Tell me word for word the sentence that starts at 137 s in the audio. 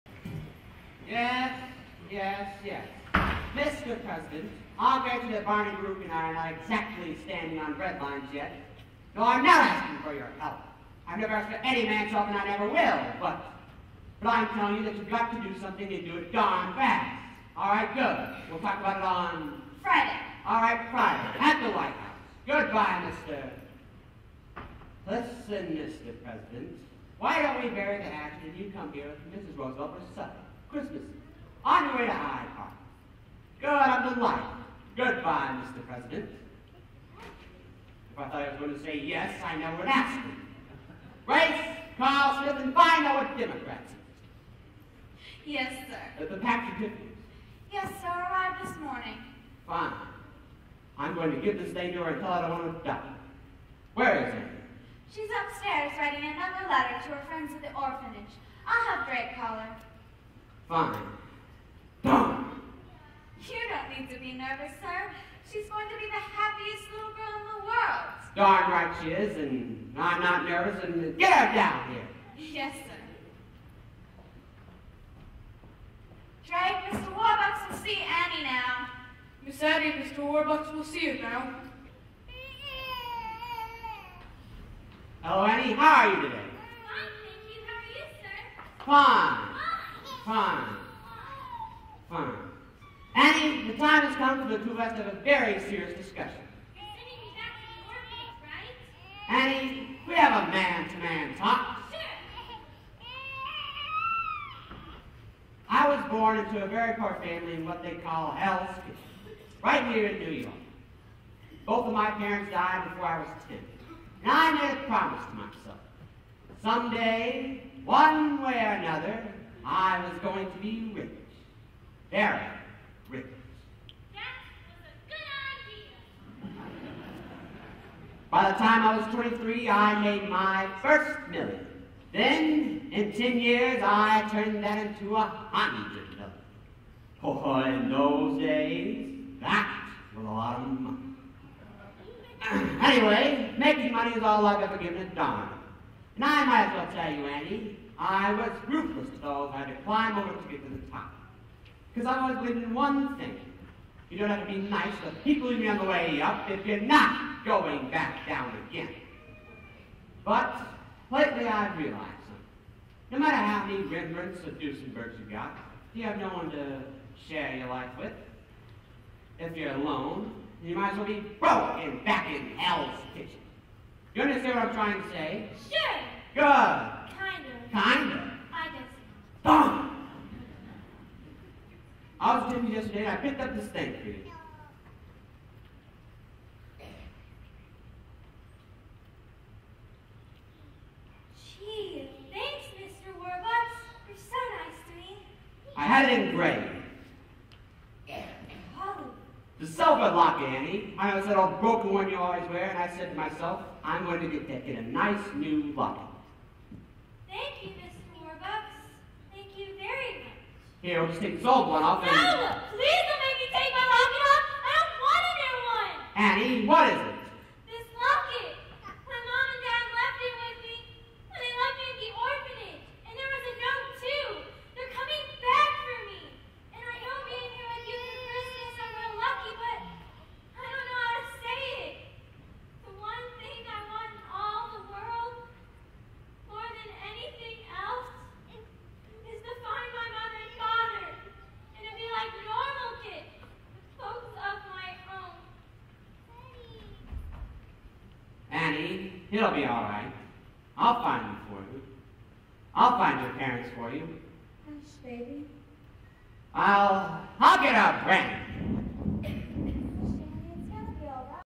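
Oh, in those days, that was a lot of money.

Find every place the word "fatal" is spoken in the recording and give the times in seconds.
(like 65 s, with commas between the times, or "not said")
not said.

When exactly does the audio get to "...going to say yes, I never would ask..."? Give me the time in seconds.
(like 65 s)
38 s.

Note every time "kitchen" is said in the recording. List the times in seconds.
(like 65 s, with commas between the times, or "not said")
108 s, 173 s.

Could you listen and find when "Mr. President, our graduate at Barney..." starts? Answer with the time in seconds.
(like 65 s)
3 s.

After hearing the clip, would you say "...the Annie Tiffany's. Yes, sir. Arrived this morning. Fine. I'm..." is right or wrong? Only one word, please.
wrong.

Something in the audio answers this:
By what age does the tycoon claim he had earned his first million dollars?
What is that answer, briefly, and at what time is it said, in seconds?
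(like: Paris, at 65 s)
23, at 129 s.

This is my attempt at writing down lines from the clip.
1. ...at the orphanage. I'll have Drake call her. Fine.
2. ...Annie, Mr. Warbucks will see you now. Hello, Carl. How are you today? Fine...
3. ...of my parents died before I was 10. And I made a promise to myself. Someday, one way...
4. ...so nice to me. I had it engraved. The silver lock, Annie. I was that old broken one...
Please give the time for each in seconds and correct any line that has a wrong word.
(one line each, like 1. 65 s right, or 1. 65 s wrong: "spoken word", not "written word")
1. 57 s right
2. 79 s wrong: "Annie", not "Carl"
3. 111 s right
4. 194 s right.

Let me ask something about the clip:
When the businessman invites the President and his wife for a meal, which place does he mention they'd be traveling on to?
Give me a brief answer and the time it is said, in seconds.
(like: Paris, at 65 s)
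Hyde Park, at 32 s.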